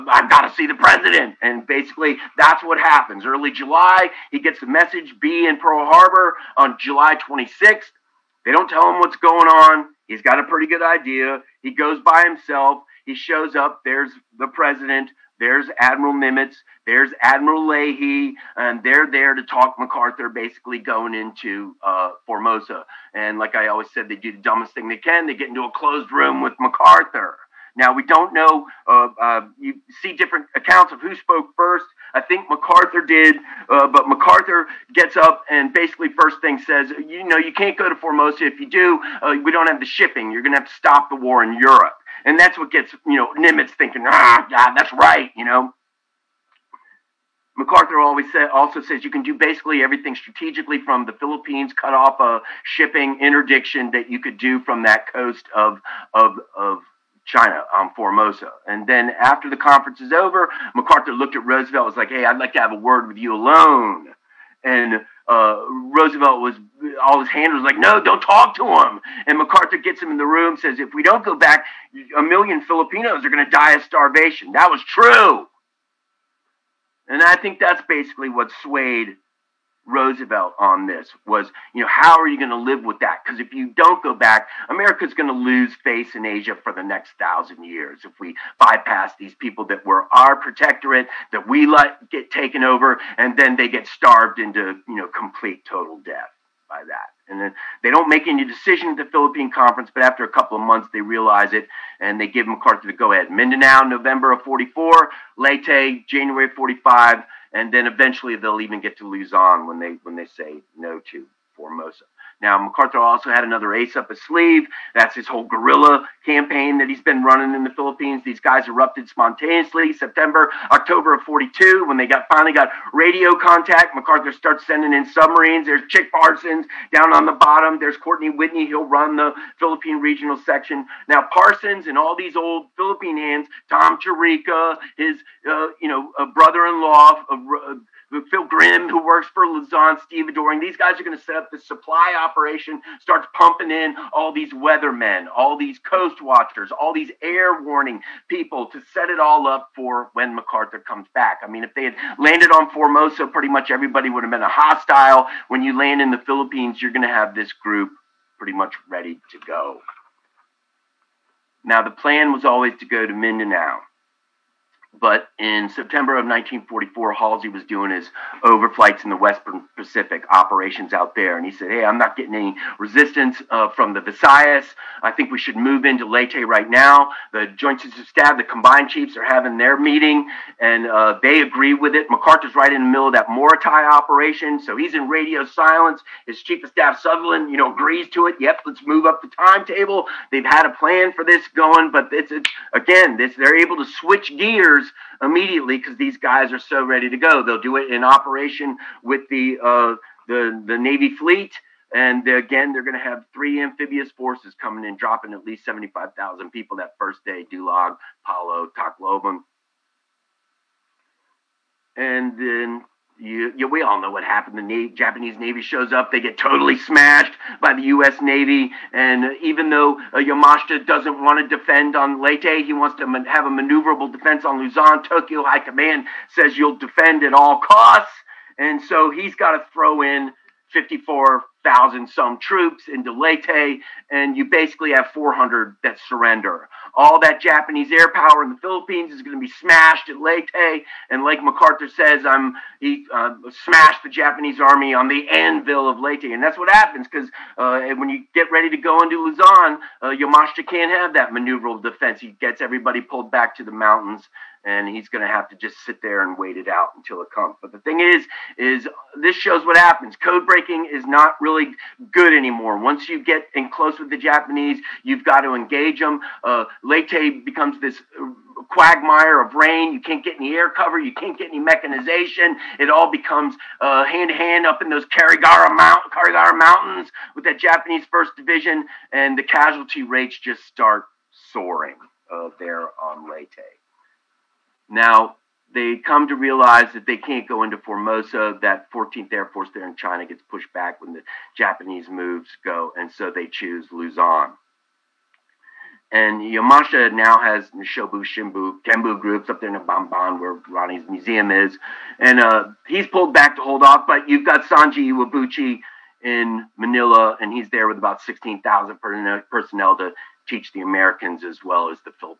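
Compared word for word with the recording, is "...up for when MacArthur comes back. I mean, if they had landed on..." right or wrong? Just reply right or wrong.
right.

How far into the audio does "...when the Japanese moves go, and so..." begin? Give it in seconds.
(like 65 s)
290 s.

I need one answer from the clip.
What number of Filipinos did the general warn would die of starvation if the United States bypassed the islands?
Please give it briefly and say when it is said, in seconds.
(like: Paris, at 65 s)
a million, at 72 s.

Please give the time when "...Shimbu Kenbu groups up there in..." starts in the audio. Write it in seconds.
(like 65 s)
298 s.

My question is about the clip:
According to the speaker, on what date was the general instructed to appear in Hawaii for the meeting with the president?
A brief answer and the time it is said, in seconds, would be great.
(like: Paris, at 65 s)
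July 26th, at 6 s.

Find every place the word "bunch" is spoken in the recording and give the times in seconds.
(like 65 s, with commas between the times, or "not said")
not said.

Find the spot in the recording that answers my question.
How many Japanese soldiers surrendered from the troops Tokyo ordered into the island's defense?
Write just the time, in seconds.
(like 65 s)
235 s.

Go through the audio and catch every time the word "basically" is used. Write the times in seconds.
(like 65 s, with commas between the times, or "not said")
1 s, 20 s, 35 s, 49 s, 77 s, 234 s.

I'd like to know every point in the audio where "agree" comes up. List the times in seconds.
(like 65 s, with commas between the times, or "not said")
181 s, 187 s.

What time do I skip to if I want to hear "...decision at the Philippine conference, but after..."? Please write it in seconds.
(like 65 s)
98 s.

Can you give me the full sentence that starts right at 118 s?
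These guys erupted spontaneously September, October of 42 when they got finally got radio contact.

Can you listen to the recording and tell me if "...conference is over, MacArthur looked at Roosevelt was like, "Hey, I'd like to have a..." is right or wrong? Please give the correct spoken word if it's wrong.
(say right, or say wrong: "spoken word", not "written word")
right.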